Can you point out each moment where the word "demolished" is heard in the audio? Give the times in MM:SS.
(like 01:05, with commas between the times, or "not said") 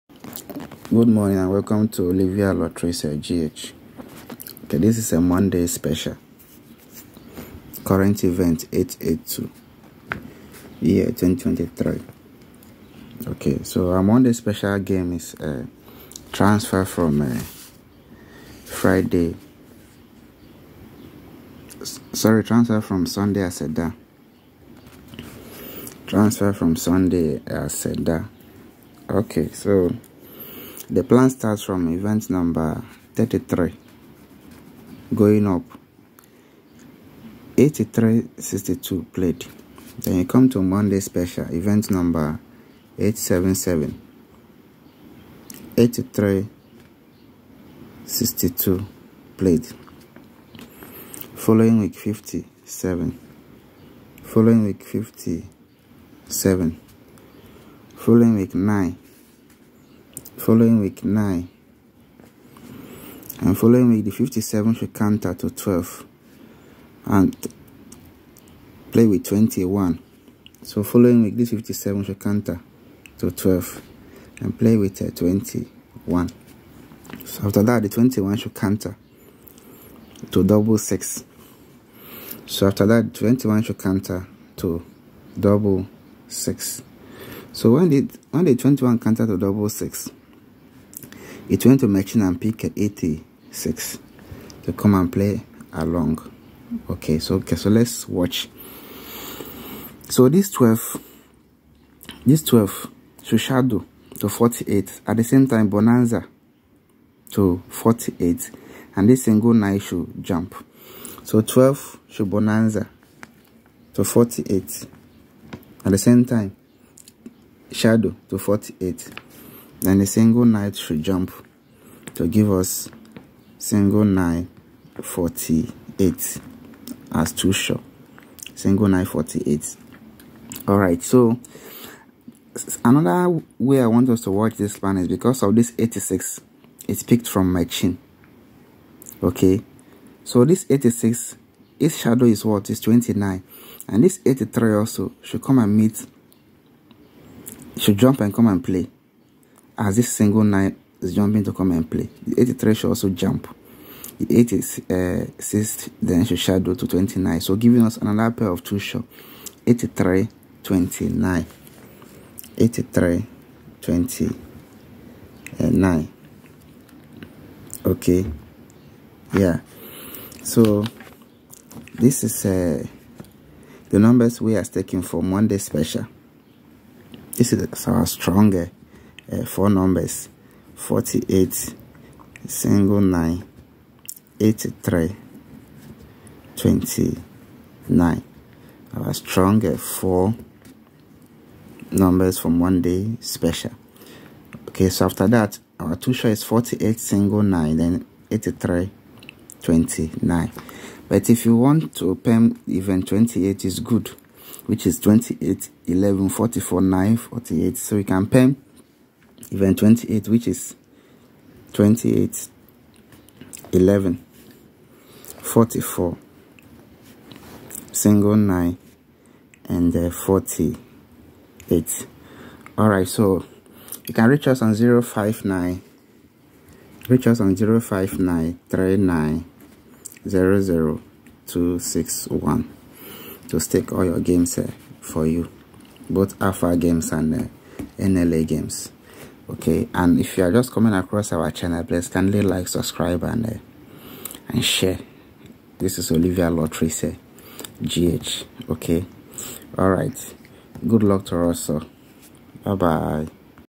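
not said.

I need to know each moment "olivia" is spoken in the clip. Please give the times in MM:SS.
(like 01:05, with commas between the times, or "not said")
00:02, 04:06.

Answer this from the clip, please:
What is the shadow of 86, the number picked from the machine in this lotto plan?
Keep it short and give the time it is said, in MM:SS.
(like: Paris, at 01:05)
29, at 02:21.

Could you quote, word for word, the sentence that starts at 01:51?
So 12 should Bonanza to 48.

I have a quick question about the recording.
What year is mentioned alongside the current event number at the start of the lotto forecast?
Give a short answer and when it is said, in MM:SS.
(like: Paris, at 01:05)
2023, at 00:10.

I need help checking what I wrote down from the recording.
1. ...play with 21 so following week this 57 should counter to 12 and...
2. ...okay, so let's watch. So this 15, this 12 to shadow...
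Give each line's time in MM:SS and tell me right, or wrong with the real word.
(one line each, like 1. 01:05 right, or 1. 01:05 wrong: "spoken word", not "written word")
1. 01:08 right
2. 01:37 wrong: "12", not "15".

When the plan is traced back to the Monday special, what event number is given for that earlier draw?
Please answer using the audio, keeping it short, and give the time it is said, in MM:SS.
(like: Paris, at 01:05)
877, at 00:41.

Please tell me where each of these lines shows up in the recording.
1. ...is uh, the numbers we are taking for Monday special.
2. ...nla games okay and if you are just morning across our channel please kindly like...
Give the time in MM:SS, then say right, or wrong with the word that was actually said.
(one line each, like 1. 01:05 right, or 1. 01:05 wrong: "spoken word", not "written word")
1. 02:52 right
2. 03:57 wrong: "coming", not "morning".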